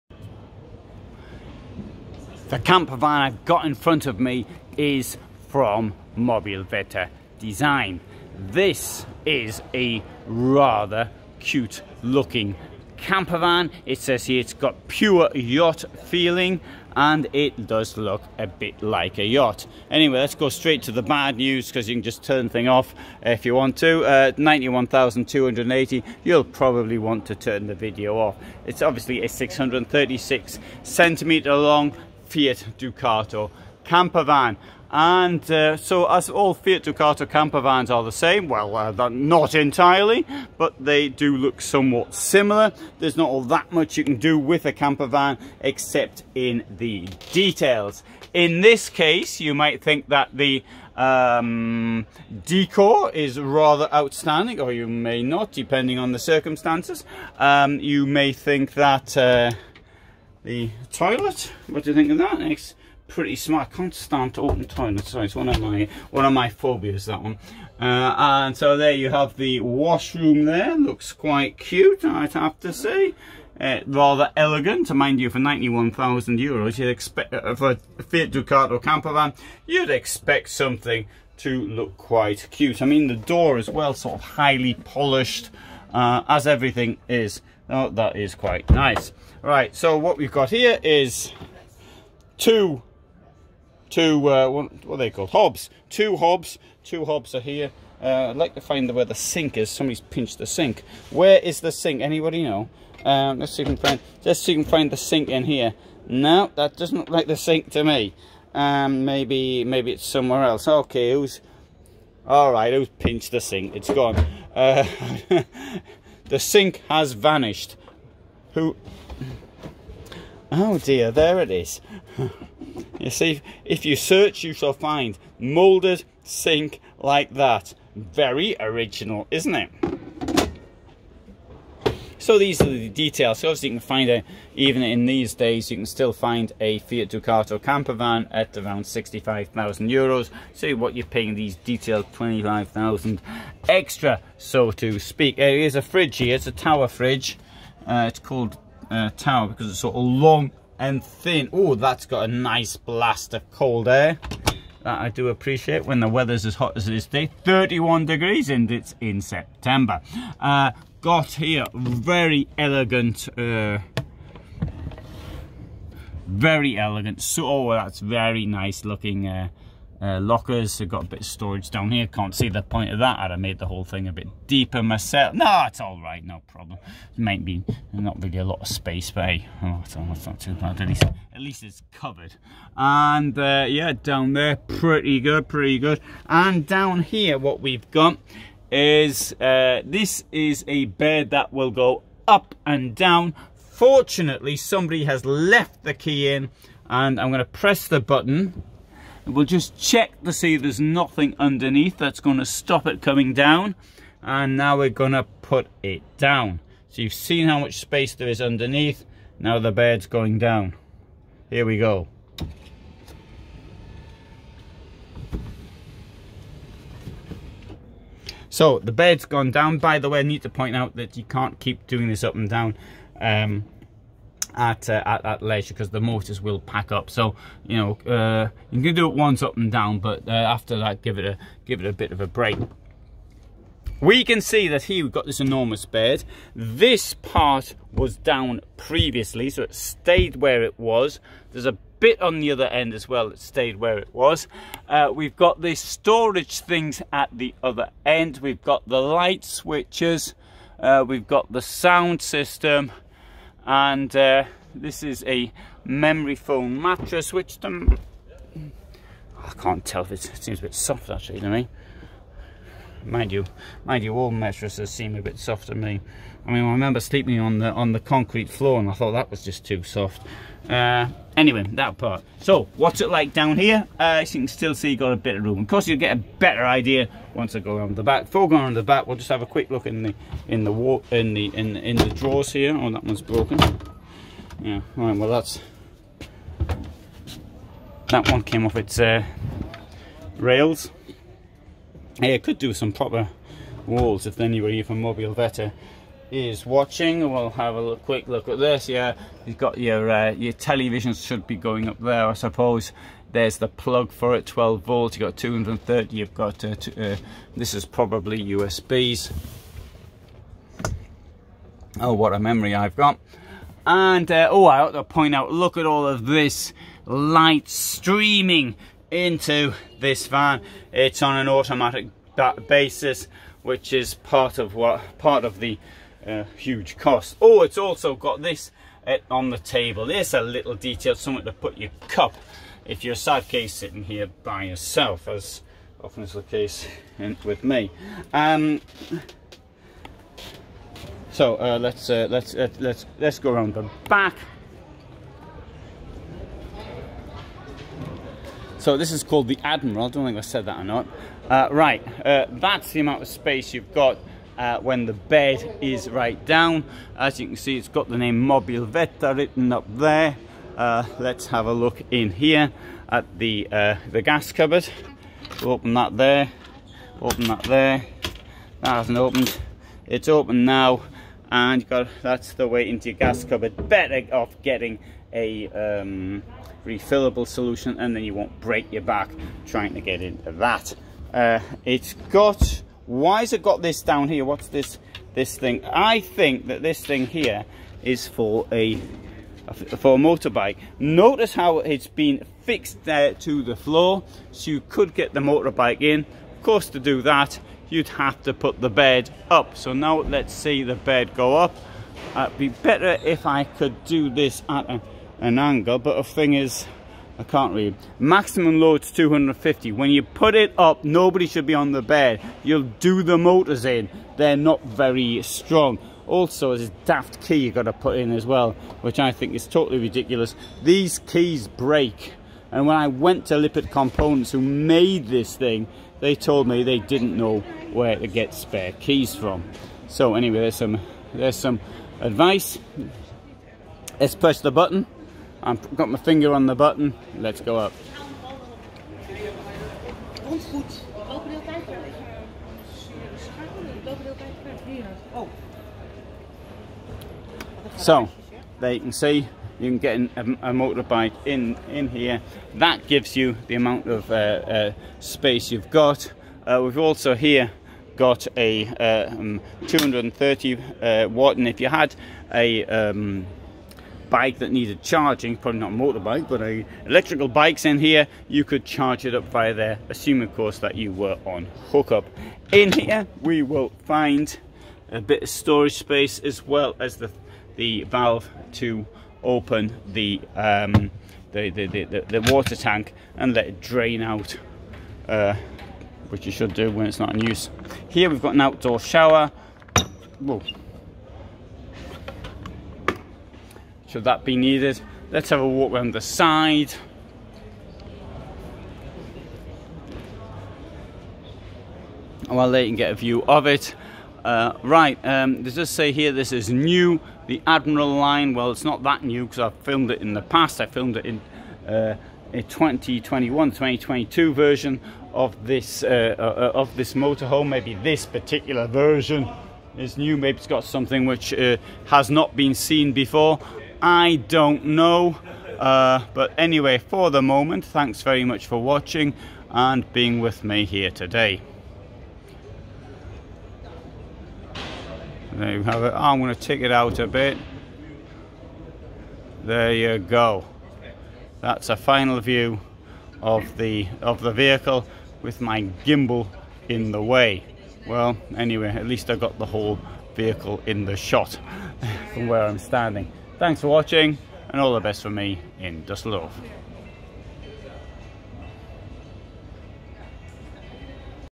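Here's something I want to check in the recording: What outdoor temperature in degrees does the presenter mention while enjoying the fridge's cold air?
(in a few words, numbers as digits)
31.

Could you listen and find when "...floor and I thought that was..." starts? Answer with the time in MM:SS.
04:28.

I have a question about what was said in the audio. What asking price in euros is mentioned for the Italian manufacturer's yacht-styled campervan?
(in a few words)
91,280.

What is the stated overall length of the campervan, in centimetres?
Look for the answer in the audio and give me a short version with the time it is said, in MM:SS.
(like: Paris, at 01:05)
636, at 00:29.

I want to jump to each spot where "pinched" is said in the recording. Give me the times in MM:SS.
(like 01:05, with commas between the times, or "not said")
01:40, 01:52.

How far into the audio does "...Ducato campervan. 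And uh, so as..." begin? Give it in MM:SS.
00:32.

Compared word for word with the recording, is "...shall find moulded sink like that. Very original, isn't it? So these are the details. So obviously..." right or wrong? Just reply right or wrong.
right.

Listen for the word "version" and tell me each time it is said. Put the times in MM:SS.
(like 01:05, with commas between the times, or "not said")
08:34, 08:38.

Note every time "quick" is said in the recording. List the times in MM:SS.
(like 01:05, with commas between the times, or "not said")
04:39, 04:57.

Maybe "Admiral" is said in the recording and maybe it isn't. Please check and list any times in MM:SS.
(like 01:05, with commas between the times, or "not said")
05:49, 08:27.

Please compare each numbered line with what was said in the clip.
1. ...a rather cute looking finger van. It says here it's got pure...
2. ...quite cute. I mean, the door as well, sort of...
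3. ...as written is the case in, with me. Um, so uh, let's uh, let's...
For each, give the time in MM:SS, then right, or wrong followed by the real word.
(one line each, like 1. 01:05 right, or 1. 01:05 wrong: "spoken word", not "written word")
1. 00:09 wrong: "camper", not "finger"
2. 01:21 right
3. 05:35 wrong: "often", not "written".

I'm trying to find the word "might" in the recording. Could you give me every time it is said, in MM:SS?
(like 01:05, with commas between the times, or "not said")
00:49, 02:57.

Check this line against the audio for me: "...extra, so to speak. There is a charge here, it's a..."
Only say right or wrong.
wrong.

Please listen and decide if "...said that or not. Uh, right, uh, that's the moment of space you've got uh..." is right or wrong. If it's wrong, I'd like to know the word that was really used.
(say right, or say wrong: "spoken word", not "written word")
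wrong: "amount", not "moment".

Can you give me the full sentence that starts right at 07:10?
So anyway, there's some, there's some advice.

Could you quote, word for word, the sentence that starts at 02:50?
I've got a bit of storage down here.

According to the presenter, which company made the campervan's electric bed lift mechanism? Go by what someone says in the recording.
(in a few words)
Lippert Components.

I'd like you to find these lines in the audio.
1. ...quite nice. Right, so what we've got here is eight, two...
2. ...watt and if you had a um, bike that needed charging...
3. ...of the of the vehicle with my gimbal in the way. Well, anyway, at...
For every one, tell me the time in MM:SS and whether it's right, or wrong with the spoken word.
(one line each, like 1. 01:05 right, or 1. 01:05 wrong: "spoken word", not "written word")
1. 01:28 wrong: "two", not "eight"
2. 07:41 right
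3. 09:03 right.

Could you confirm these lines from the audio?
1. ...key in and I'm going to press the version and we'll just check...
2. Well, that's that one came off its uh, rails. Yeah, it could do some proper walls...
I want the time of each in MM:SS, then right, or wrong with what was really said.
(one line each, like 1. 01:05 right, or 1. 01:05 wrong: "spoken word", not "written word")
1. 03:15 wrong: "button", not "version"
2. 04:45 right.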